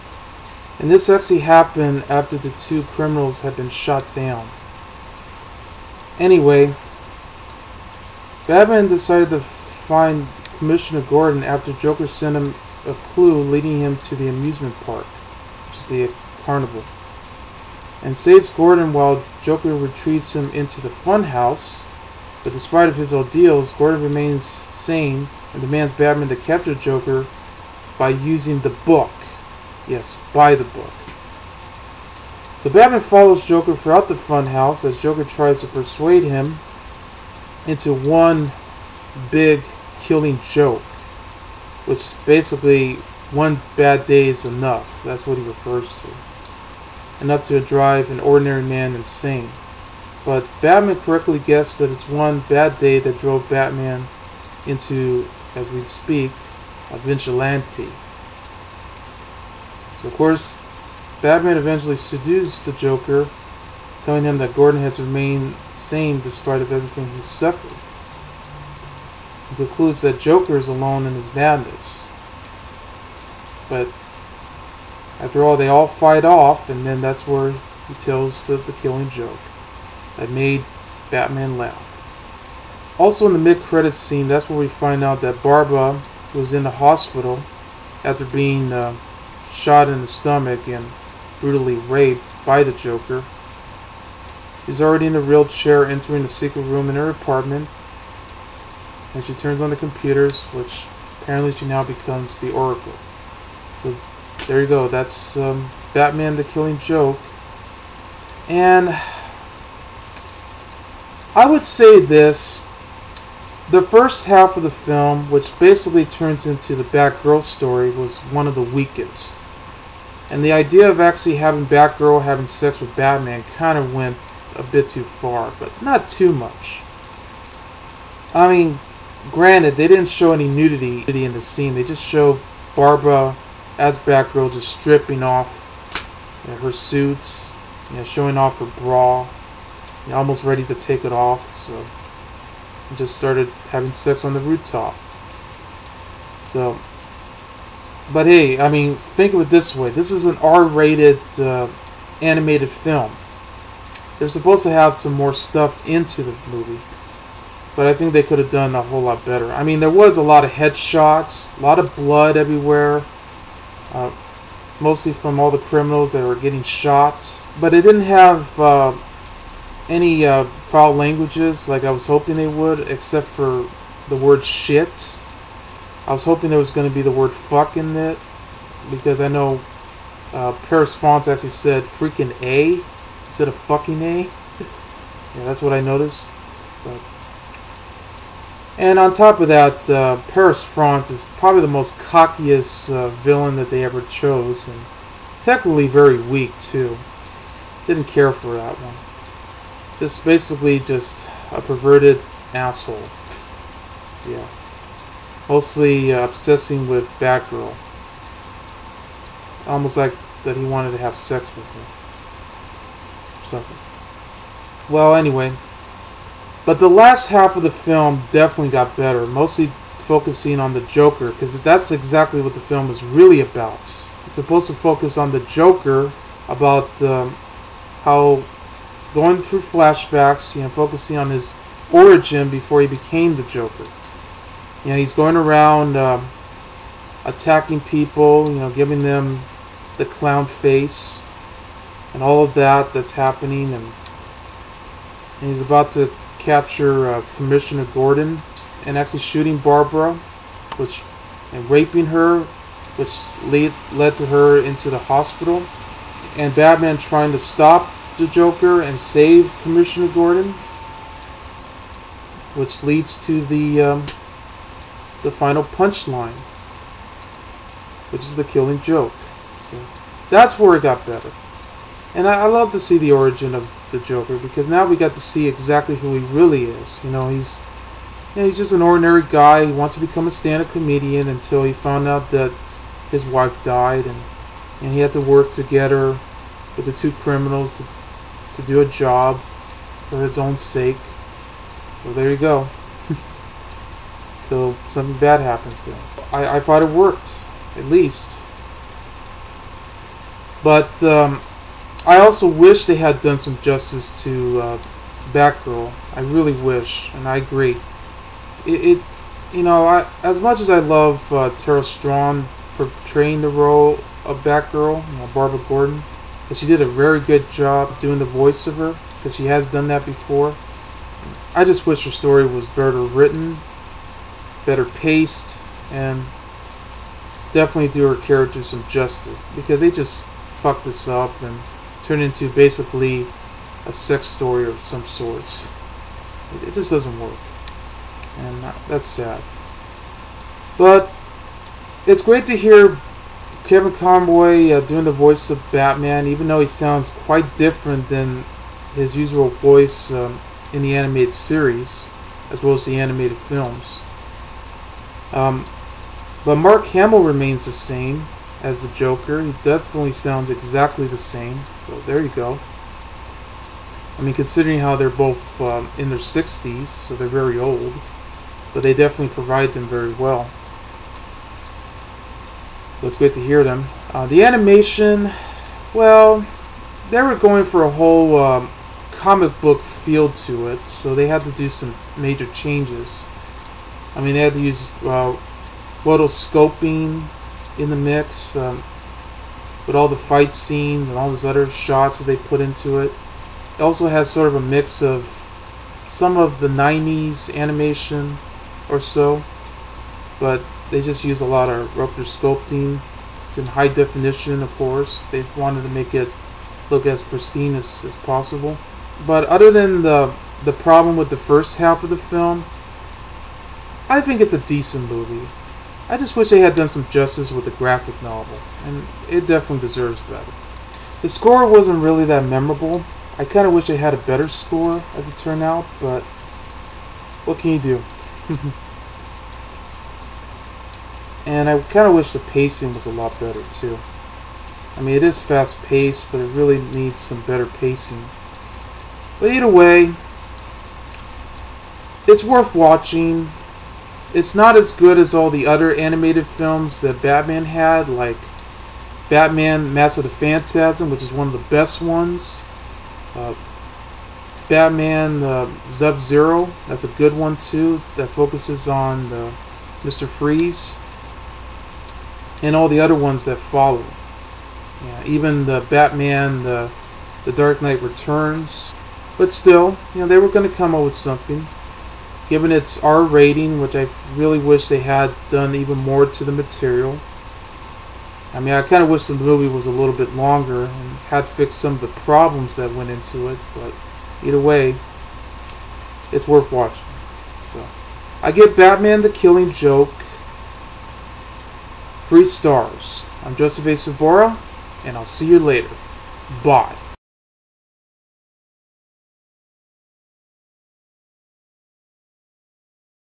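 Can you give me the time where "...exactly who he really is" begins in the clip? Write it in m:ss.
4:35.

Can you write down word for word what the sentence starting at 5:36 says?
it just doesn't work, and uh, that's sad.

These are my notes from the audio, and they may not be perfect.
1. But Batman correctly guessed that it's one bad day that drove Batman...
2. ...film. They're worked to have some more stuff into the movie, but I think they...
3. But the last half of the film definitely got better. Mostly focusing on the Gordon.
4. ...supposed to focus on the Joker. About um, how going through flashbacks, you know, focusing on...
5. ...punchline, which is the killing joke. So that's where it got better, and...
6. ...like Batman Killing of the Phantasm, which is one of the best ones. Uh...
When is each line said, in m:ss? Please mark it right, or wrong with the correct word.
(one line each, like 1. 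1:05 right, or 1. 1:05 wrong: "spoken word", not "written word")
1. 0:50 right
2. 2:32 wrong: "supposed", not "worked"
3. 3:36 wrong: "Joker", not "Gordon"
4. 3:44 right
5. 4:25 right
6. 7:28 wrong: "Mask", not "Killing".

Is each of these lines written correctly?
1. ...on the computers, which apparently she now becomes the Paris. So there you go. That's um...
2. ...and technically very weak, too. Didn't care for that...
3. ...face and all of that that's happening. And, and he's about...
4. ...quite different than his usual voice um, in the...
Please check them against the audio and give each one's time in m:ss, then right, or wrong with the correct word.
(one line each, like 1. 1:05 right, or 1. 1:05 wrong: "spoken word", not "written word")
1. 1:39 wrong: "Oracle", not "Paris"
2. 3:14 right
3. 4:00 right
4. 5:47 right.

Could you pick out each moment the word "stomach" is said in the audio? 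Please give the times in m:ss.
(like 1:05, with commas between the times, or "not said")
1:30.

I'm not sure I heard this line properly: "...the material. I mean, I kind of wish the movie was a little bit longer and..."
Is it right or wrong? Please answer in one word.
right.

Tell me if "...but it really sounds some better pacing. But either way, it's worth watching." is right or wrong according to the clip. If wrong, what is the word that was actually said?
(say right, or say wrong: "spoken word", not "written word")
wrong: "needs", not "sounds".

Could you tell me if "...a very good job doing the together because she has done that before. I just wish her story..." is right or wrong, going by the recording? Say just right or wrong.
wrong.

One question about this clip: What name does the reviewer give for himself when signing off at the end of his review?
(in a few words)
Joseph A. Sobora.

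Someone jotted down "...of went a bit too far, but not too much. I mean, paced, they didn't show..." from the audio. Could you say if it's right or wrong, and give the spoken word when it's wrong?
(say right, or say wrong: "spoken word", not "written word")
wrong: "granted", not "paced".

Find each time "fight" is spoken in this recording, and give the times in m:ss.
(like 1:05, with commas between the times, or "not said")
1:15, 6:30.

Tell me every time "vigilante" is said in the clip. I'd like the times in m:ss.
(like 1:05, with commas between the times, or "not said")
0:56.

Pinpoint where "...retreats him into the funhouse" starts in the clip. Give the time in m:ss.
0:19.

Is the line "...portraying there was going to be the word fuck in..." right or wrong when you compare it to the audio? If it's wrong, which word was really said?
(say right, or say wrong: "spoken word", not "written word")
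wrong: "hoping", not "portraying".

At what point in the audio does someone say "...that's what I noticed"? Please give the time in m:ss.
3:05.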